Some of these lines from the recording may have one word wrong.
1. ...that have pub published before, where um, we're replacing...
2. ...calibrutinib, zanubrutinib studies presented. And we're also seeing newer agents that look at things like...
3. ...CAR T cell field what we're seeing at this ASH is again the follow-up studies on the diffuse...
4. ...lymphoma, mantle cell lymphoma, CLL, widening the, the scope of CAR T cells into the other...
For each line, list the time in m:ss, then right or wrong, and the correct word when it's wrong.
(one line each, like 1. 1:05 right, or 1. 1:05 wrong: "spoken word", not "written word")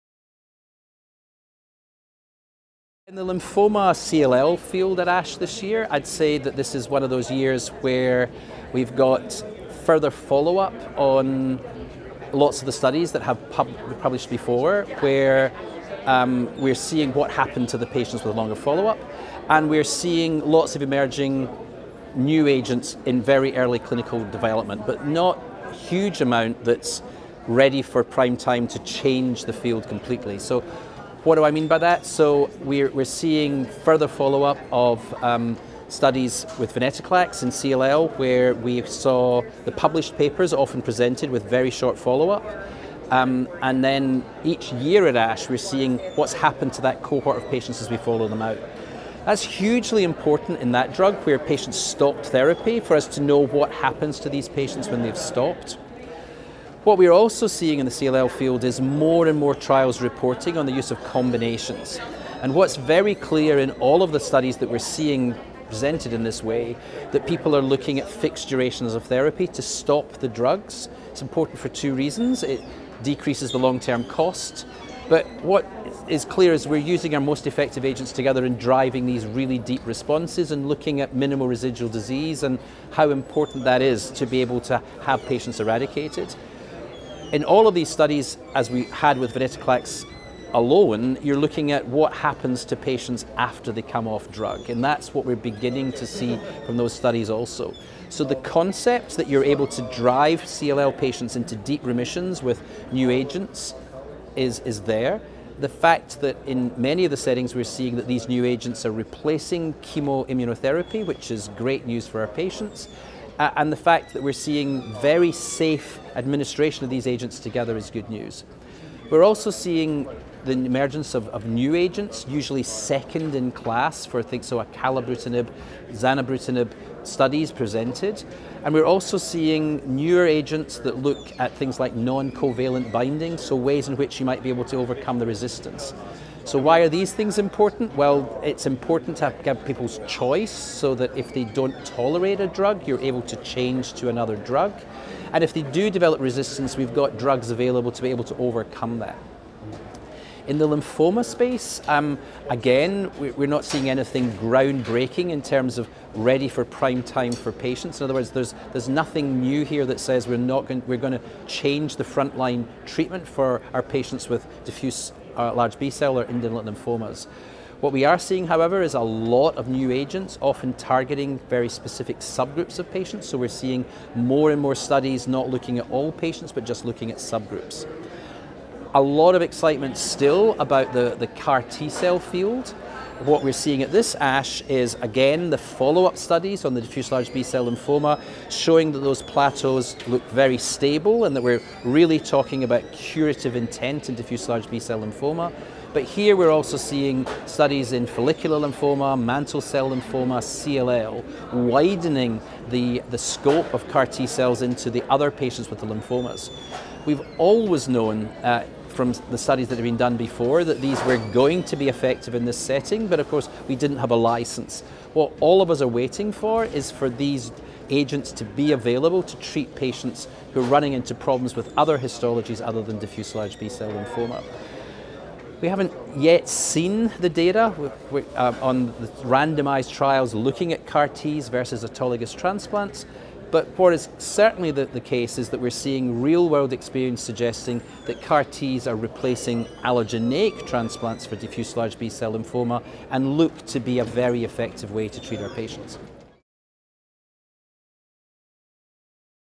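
1. 0:13 wrong: "seeing", not "replacing"
2. 2:04 right
3. 3:01 right
4. 3:18 right.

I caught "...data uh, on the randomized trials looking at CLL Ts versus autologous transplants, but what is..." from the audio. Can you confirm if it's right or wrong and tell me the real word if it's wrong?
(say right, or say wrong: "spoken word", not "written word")
wrong: "CAR", not "CLL".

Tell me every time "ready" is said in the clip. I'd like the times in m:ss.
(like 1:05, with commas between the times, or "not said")
0:27, 2:36.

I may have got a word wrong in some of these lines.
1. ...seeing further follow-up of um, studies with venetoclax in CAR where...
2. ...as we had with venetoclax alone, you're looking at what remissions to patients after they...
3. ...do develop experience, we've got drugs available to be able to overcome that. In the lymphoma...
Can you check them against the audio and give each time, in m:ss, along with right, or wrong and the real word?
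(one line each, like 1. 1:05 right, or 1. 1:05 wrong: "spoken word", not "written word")
1. 0:33 wrong: "CLL", not "CAR"
2. 1:28 wrong: "happens", not "remissions"
3. 2:25 wrong: "resistance", not "experience".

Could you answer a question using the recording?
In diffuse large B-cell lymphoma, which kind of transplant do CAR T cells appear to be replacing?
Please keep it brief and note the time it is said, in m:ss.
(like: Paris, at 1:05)
allogeneic transplants, at 3:59.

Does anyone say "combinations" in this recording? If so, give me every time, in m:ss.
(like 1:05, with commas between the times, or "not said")
1:01.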